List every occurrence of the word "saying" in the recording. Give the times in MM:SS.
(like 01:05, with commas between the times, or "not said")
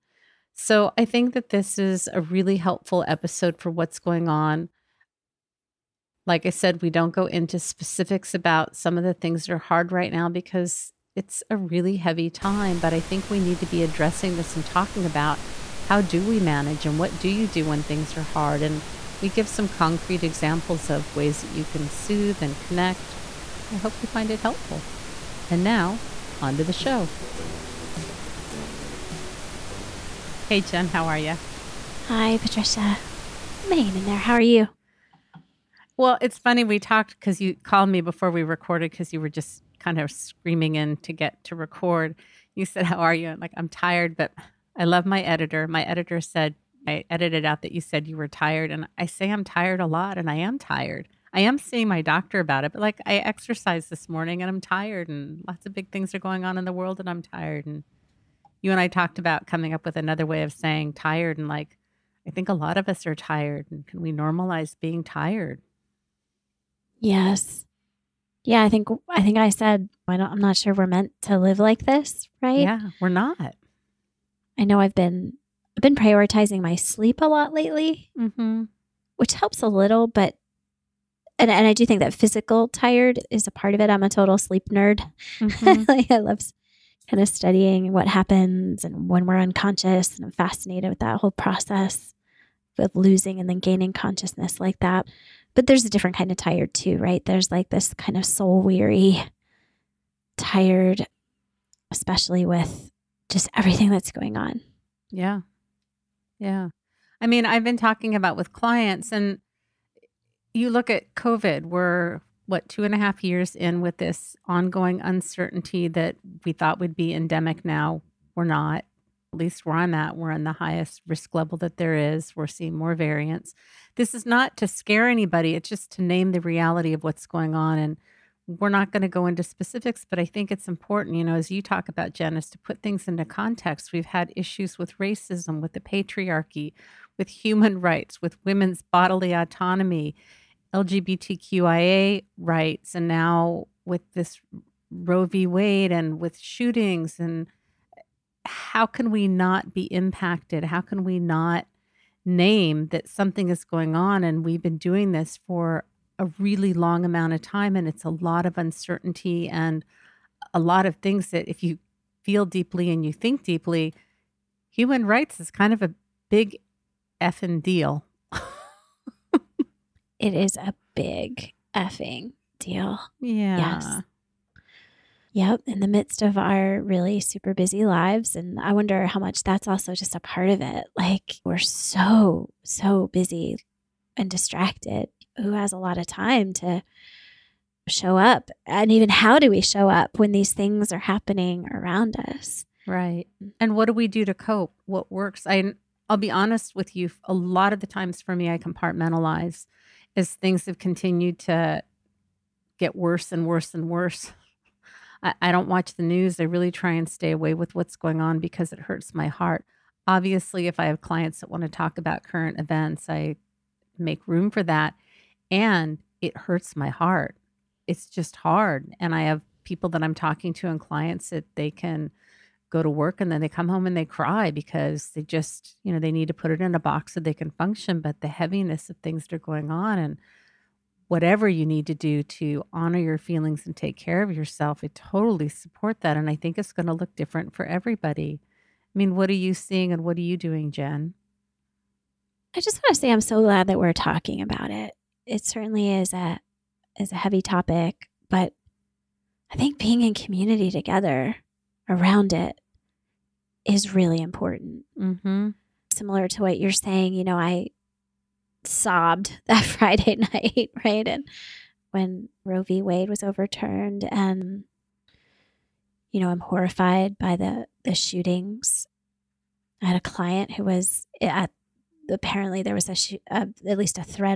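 01:00, 04:16.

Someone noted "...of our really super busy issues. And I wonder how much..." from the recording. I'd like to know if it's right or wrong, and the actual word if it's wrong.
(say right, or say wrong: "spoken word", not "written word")
wrong: "lives", not "issues".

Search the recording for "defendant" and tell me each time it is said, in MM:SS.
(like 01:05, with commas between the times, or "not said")
not said.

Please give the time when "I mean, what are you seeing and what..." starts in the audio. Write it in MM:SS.
03:58.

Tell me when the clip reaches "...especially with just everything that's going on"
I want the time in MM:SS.
01:41.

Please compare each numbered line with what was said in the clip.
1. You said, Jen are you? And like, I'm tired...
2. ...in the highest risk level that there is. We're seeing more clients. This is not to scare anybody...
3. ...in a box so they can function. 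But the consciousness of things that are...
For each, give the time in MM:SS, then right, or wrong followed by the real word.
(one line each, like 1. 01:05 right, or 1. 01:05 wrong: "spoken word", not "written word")
1. 00:42 wrong: "How", not "Jen"
2. 02:00 wrong: "variants", not "clients"
3. 03:46 wrong: "heaviness", not "consciousness".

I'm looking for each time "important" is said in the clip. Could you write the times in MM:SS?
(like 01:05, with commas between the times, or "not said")
02:10, 04:14.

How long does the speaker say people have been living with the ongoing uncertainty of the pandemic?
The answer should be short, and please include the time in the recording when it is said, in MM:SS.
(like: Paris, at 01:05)
2.5 years, at 01:52.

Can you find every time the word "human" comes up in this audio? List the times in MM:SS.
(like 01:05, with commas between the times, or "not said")
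02:17, 02:44.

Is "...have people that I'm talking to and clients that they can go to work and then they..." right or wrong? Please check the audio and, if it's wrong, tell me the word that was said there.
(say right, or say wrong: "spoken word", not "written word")
right.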